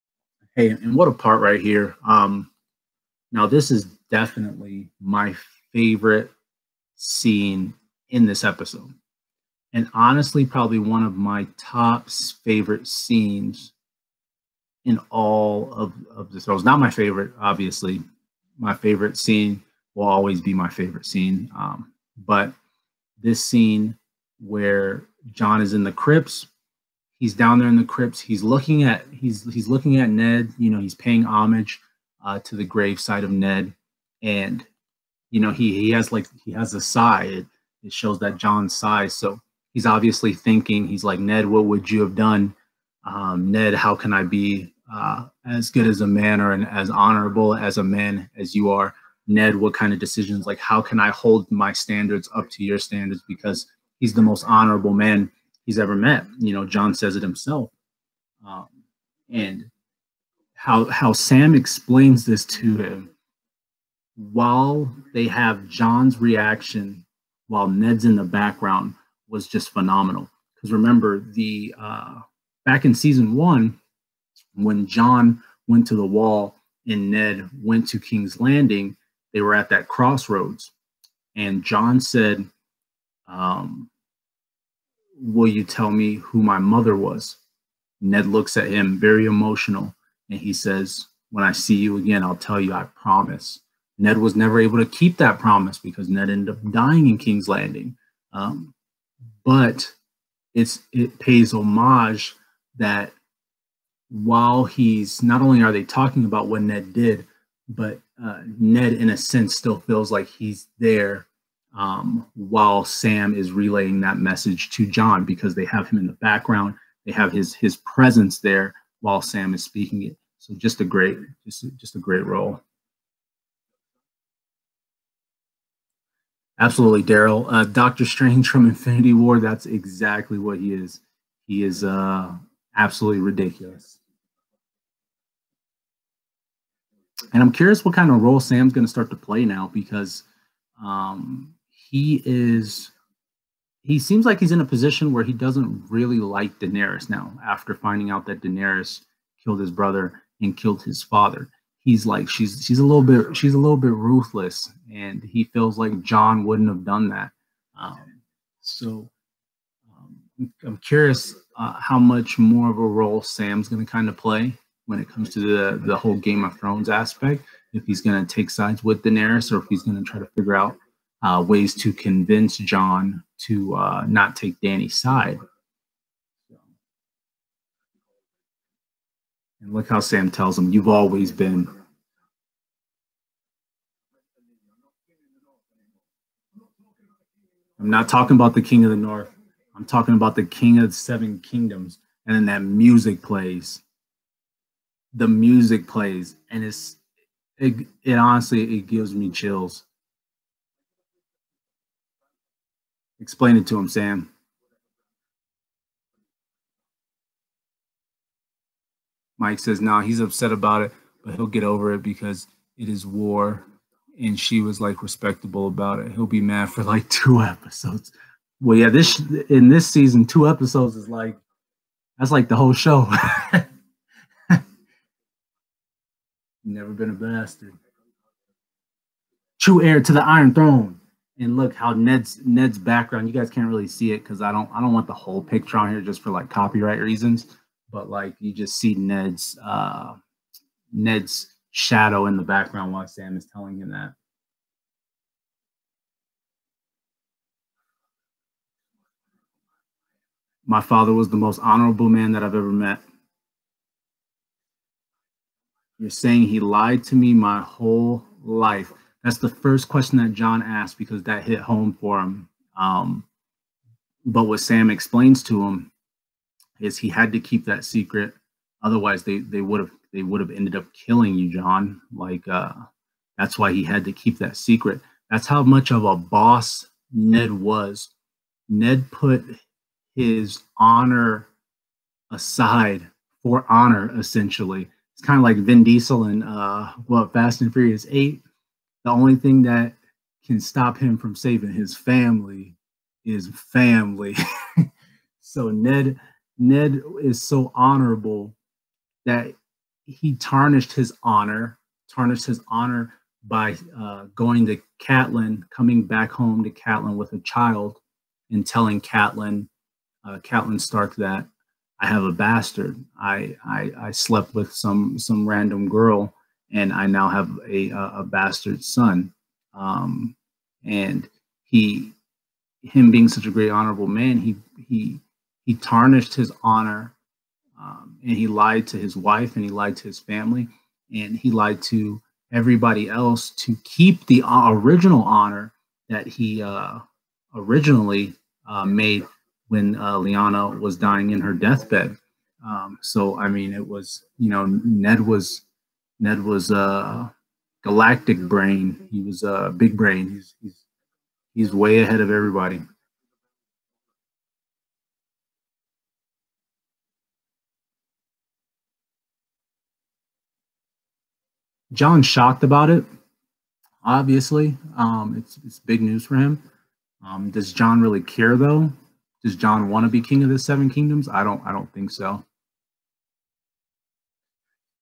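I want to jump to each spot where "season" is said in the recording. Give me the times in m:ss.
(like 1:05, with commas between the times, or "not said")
1:12, 3:39.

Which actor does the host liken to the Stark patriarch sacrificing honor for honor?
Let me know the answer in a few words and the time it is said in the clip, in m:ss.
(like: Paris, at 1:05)
Vin Diesel, at 4:45.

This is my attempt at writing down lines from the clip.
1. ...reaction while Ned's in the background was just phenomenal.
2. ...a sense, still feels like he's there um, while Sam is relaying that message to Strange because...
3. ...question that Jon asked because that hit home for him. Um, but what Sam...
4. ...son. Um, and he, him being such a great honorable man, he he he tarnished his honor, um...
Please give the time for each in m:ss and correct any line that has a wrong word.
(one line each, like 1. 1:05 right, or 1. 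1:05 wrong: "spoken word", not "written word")
1. 1:06 right
2. 1:49 wrong: "Jon", not "Strange"
3. 4:19 right
4. 5:18 right.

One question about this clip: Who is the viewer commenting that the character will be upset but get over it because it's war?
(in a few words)
Mike.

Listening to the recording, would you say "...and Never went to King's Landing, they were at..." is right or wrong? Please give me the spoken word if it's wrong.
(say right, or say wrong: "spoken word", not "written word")
wrong: "Ned", not "Never".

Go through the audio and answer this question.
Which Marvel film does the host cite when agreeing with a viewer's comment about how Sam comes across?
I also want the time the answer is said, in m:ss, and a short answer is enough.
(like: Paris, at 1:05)
Infinity War, at 2:08.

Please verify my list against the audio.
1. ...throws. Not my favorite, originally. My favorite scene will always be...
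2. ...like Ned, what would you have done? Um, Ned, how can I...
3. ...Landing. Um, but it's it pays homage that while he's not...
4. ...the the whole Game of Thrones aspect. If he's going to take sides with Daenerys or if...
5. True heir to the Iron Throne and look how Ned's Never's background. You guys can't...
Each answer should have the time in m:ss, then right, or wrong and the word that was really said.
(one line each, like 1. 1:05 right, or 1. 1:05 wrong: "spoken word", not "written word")
1. 0:16 wrong: "obviously", not "originally"
2. 0:41 right
3. 1:37 right
4. 2:45 right
5. 3:49 wrong: "Ned", not "Never".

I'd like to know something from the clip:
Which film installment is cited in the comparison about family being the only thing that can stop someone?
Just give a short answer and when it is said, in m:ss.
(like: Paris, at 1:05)
Fast and Furious 8, at 4:47.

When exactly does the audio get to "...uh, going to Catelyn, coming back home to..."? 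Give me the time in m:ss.
5:03.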